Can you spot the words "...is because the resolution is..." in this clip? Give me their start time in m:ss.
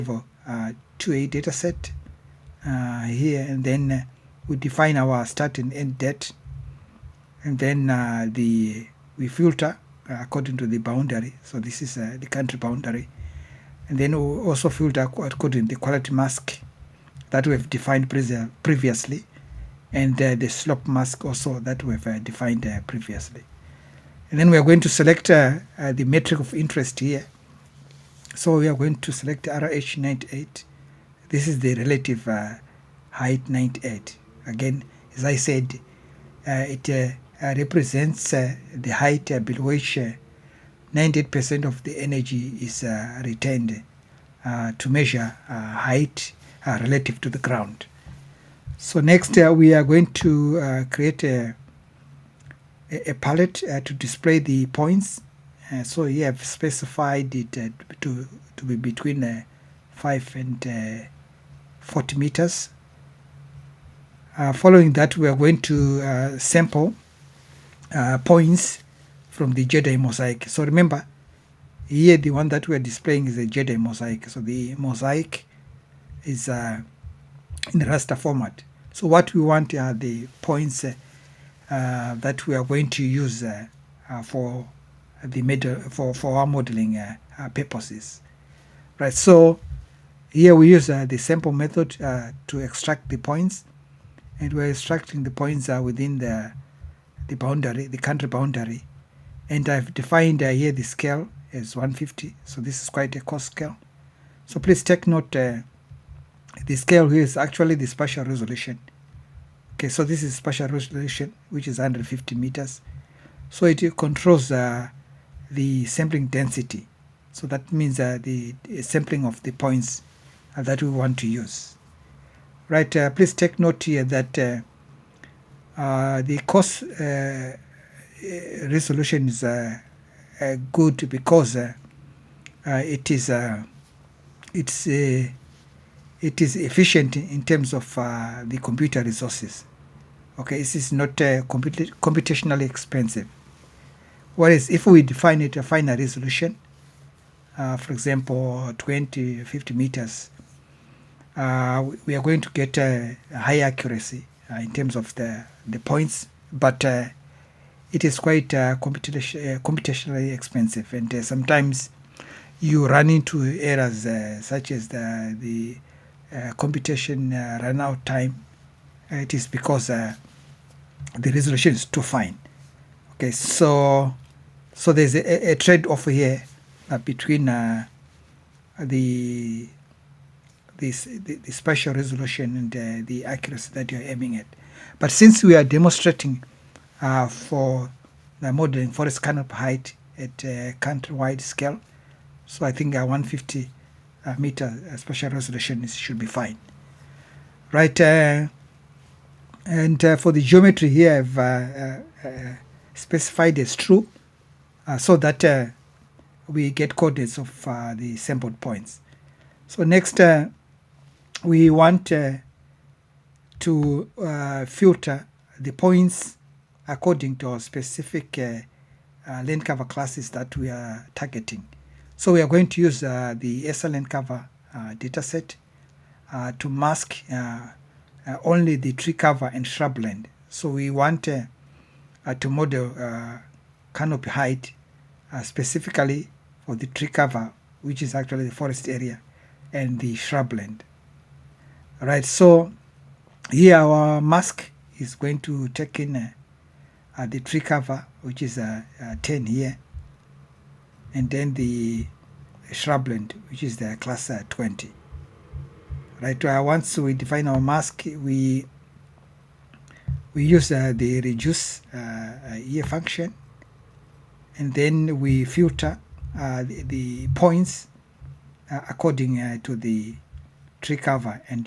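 2:49.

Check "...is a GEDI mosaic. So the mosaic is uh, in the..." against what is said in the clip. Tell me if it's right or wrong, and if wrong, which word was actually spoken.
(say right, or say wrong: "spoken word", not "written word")
right.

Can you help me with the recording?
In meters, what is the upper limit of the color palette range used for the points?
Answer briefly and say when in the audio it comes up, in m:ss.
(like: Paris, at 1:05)
40 meters, at 1:01.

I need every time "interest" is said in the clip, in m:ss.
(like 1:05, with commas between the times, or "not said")
0:26.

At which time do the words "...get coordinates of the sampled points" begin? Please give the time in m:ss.
3:26.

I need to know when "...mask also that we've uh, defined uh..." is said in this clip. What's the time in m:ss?
0:20.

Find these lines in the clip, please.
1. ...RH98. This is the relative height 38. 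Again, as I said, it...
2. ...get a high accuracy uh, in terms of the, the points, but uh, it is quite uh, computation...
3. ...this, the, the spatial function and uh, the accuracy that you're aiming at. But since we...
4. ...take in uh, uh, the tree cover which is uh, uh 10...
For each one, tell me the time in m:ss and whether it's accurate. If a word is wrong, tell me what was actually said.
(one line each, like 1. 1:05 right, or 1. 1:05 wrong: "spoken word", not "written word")
1. 0:29 wrong: "98", not "38"
2. 2:32 right
3. 3:00 wrong: "resolution", not "function"
4. 4:05 right.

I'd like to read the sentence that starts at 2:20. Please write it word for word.
Okay, this is not comput computationally expensive.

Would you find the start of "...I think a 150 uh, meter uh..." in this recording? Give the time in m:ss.
3:12.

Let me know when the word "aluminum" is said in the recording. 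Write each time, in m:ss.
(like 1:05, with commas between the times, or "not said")
not said.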